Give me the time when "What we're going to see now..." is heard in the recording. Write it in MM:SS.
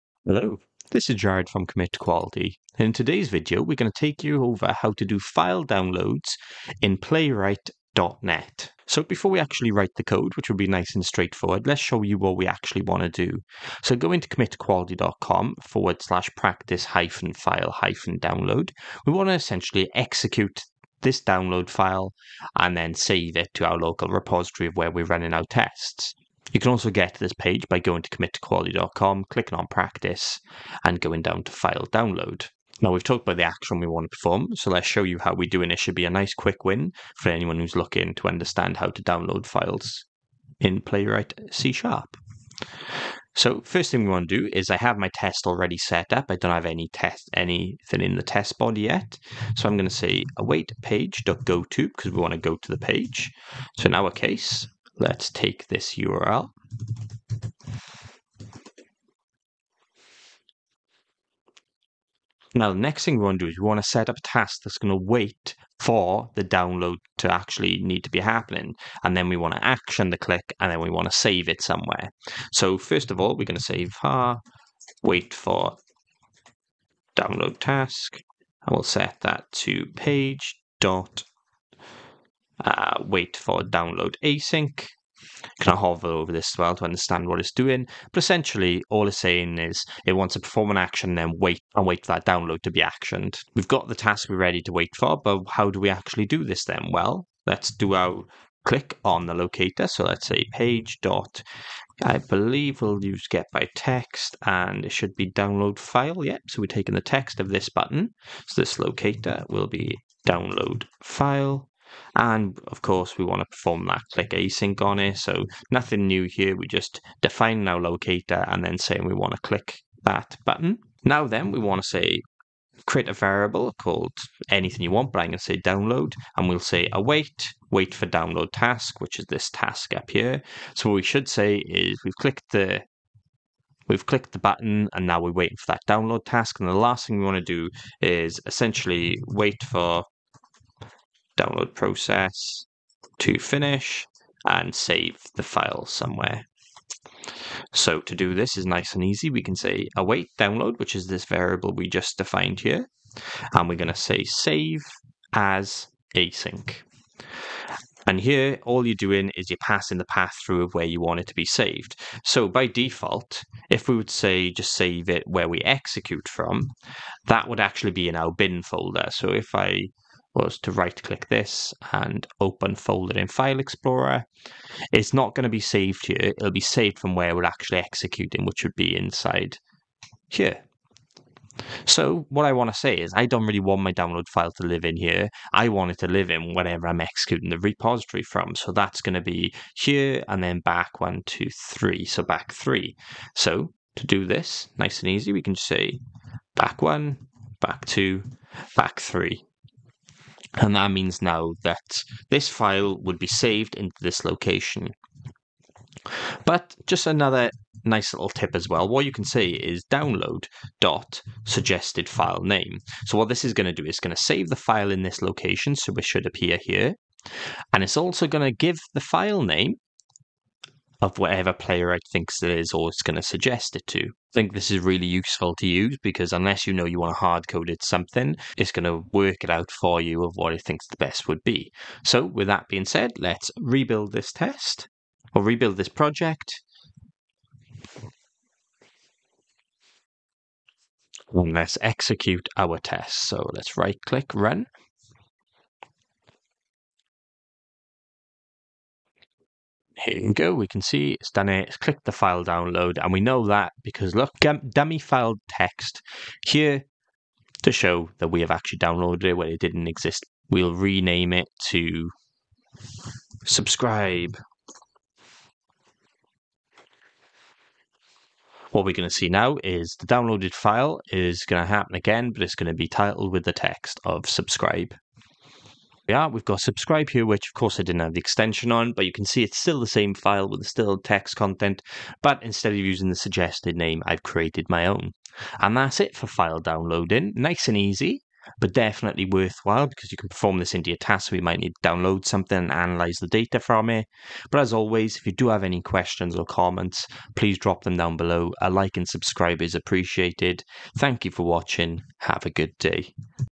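04:28.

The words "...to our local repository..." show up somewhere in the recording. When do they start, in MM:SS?
00:23.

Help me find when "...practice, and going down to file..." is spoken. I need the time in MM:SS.
00:29.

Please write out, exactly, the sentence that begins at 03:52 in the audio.
So, with that being said, let's rebuild this test or rebuild this project.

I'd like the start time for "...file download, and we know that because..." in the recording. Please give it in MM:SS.
04:12.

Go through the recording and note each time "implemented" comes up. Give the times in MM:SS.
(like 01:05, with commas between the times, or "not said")
not said.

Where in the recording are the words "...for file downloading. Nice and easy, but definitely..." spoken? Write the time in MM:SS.
04:46.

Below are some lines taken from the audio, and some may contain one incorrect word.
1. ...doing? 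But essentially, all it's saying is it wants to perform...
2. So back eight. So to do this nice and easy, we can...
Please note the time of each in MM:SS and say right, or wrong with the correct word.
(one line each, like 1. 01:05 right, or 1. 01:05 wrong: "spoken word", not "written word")
1. 01:27 right
2. 03:12 wrong: "three", not "eight".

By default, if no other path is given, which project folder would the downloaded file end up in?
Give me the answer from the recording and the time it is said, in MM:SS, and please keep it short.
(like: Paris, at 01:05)
bin folder, at 02:48.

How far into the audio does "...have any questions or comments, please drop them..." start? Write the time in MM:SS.
04:55.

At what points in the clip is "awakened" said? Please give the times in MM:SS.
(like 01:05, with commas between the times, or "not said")
not said.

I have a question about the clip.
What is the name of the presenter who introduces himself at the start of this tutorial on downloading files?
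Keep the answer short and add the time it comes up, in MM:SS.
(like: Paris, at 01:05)
Jared, at 00:01.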